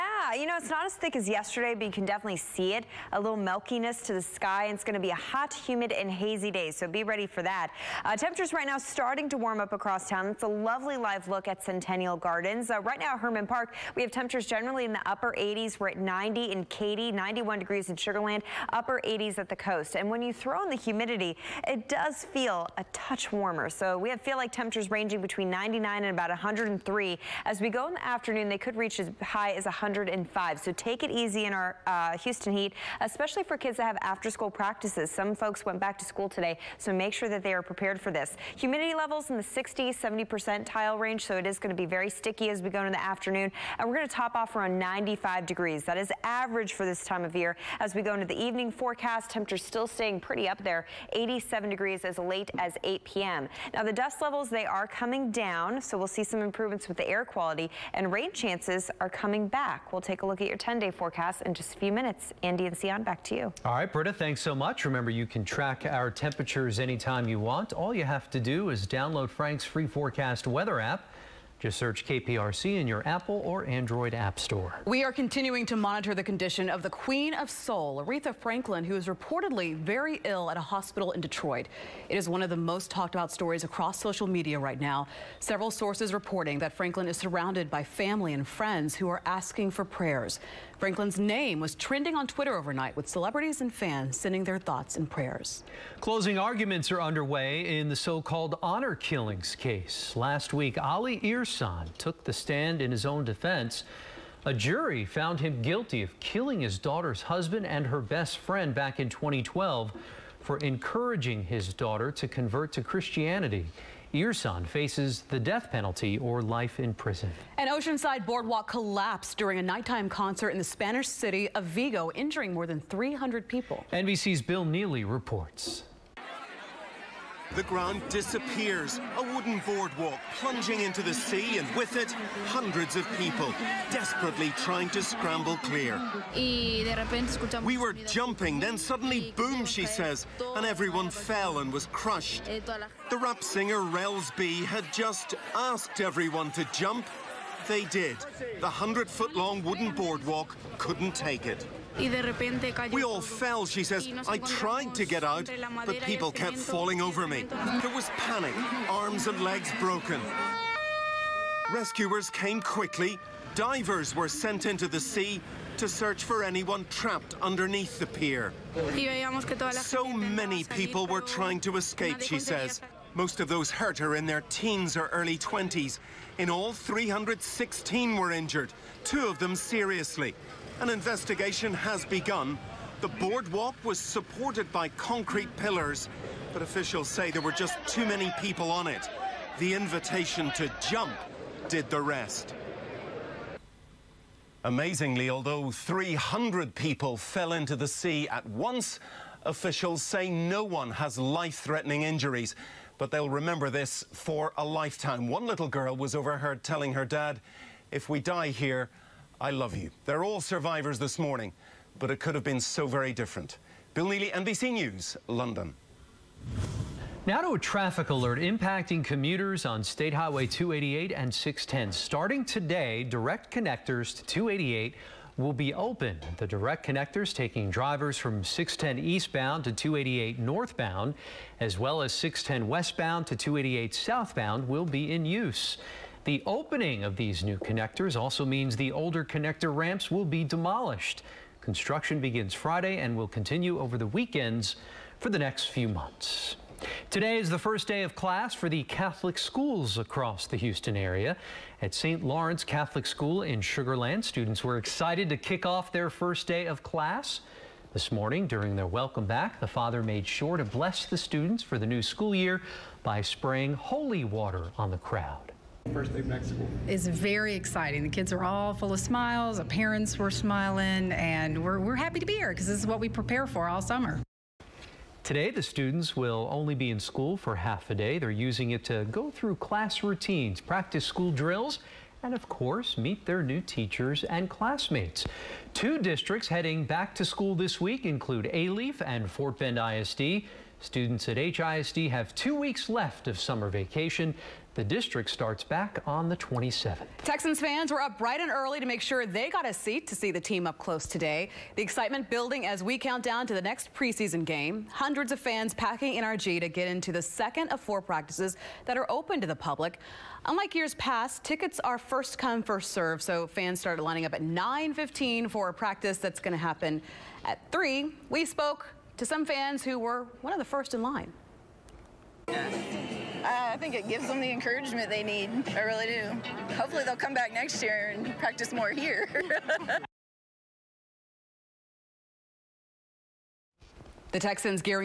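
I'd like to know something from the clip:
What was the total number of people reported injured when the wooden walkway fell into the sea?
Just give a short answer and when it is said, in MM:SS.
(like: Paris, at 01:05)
316, at 02:56.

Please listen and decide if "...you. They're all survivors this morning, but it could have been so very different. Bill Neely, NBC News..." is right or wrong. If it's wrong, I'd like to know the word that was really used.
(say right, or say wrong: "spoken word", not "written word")
right.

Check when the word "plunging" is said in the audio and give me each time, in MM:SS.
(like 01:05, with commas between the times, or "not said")
02:10.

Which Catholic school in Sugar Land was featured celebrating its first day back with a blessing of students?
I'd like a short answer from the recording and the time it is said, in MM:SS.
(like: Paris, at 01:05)
St. Lawrence Catholic School, at 04:11.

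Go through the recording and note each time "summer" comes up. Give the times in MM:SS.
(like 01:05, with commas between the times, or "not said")
04:33, 04:53.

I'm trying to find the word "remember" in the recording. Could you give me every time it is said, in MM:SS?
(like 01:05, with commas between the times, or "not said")
01:04, 03:23.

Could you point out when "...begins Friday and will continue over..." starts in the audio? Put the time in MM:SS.
04:02.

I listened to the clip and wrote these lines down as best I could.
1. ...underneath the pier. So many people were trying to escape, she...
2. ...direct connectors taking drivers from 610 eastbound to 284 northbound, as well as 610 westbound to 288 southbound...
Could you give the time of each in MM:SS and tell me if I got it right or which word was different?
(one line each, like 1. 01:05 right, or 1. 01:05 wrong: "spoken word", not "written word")
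1. 02:47 right
2. 03:46 wrong: "288", not "284".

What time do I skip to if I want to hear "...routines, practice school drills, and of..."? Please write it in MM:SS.
04:40.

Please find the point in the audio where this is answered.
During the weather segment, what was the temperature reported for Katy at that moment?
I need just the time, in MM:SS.
00:15.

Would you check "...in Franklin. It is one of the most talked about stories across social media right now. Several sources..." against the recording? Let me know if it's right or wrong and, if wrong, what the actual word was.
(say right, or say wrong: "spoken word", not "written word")
wrong: "Detroit", not "Franklin".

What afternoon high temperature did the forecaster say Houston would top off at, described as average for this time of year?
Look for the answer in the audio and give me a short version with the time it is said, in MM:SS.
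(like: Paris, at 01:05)
95 degrees, at 00:44.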